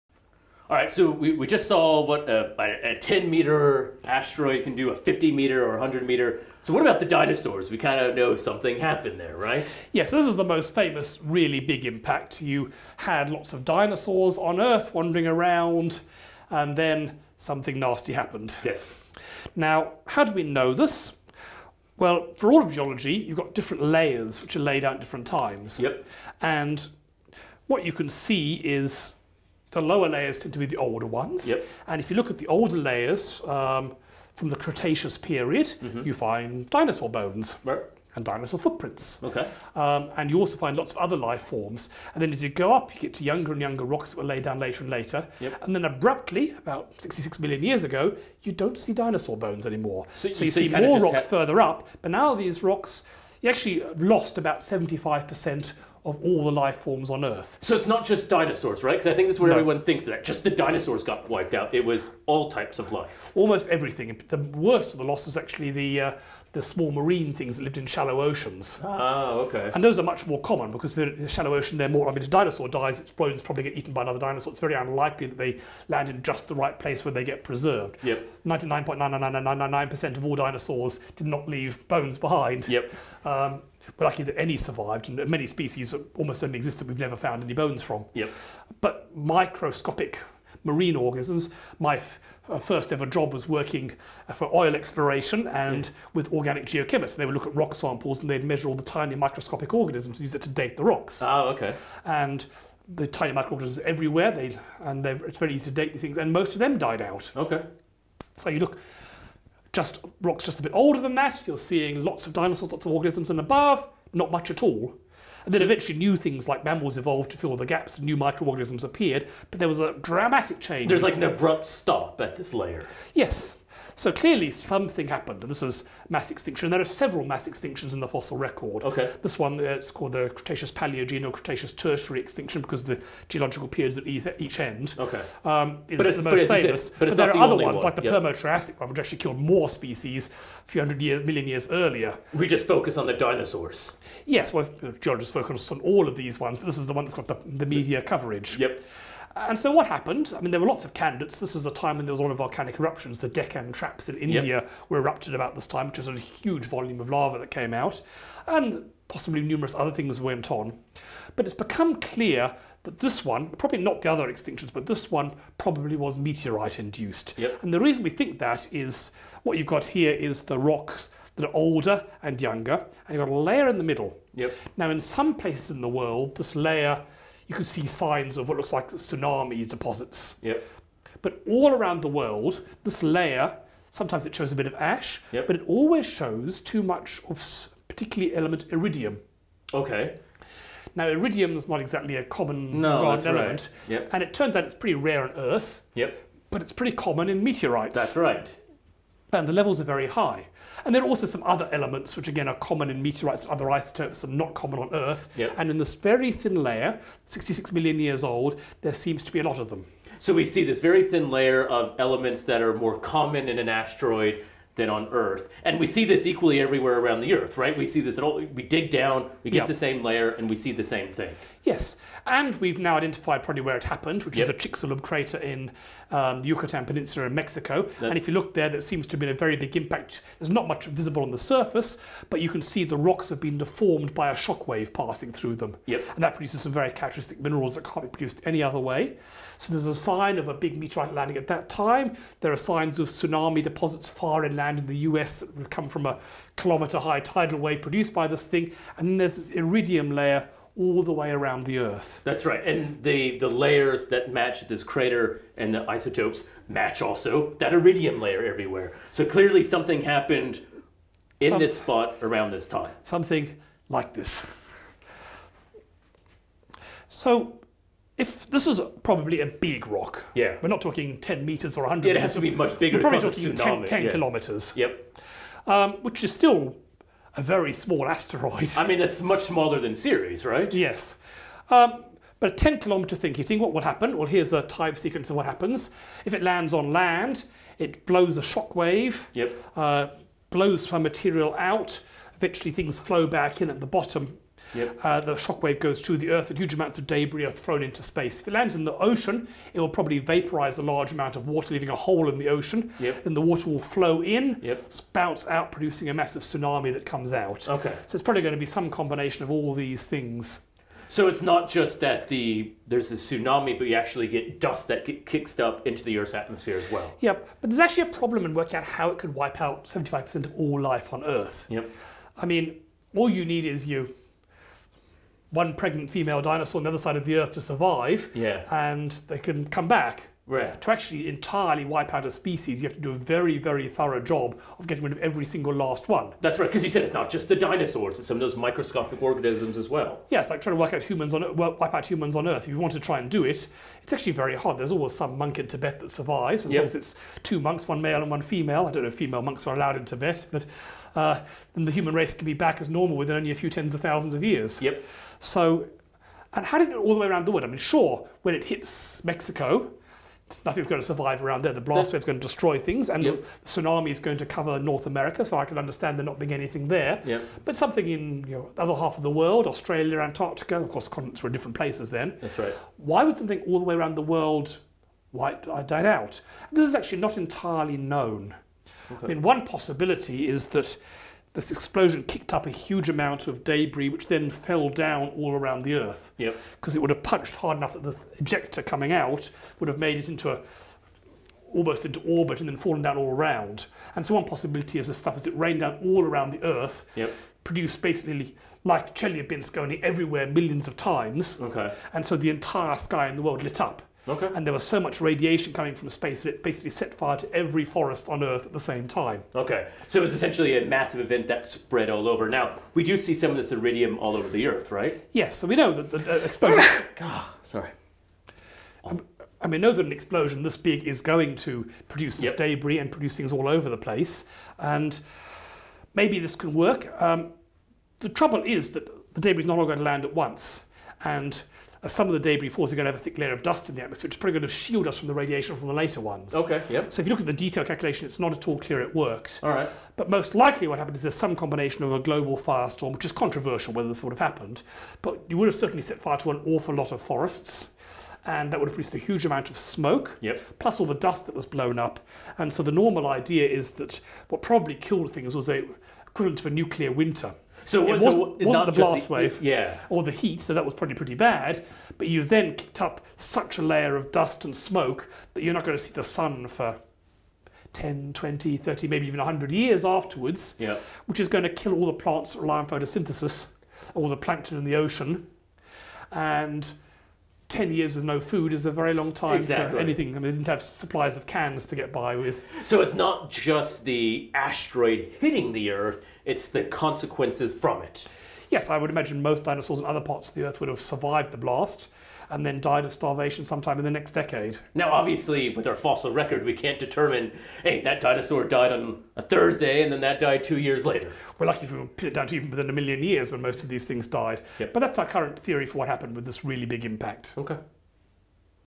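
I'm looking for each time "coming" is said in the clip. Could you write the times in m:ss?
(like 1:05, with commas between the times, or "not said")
6:28, 6:45.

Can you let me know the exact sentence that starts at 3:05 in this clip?
but it always shows too much of particularly element iridium.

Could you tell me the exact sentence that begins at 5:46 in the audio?
it's two monks, one male and one female.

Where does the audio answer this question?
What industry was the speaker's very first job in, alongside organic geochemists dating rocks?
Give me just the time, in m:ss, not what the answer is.
1:34.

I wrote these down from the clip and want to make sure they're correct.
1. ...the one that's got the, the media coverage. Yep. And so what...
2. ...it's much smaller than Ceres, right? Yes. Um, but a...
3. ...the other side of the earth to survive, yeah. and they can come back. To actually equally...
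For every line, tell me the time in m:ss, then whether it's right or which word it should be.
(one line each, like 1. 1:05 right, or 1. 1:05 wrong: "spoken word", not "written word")
1. 2:26 right
2. 4:38 right
3. 5:26 wrong: "entirely", not "equally".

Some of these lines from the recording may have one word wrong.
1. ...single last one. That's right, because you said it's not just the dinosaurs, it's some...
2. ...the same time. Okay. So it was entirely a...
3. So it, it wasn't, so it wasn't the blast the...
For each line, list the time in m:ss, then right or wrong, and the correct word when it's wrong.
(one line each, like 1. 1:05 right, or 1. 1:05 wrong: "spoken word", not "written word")
1. 5:35 right
2. 6:48 wrong: "essentially", not "entirely"
3. 7:37 right.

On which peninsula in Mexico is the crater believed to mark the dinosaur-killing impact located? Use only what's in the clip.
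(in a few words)
Yucatan Peninsula.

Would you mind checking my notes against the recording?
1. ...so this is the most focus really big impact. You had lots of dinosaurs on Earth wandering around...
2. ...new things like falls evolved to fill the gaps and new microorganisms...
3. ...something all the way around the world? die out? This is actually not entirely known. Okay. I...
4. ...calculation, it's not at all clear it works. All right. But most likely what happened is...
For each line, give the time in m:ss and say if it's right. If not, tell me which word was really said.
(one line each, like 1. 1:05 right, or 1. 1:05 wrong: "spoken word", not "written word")
1. 0:10 wrong: "famous", not "focus"
2. 1:55 wrong: "mammals", not "falls"
3. 6:13 right
4. 7:17 right.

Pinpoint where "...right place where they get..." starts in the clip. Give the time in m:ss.
1:16.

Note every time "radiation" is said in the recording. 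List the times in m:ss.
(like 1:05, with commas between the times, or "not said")
6:45, 7:15.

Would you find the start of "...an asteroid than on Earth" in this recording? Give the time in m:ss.
3:33.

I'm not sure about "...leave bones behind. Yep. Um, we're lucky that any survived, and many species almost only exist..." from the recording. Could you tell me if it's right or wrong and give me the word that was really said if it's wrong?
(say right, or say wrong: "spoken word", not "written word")
right.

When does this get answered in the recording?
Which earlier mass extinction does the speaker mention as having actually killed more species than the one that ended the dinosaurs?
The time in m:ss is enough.
2:18.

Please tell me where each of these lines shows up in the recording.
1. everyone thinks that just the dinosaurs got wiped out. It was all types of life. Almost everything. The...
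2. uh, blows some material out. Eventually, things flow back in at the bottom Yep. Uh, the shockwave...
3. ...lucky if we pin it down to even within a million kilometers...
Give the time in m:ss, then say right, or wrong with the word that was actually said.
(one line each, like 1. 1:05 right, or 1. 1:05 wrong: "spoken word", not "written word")
1. 0:59 right
2. 4:49 right
3. 8:21 wrong: "years", not "kilometers".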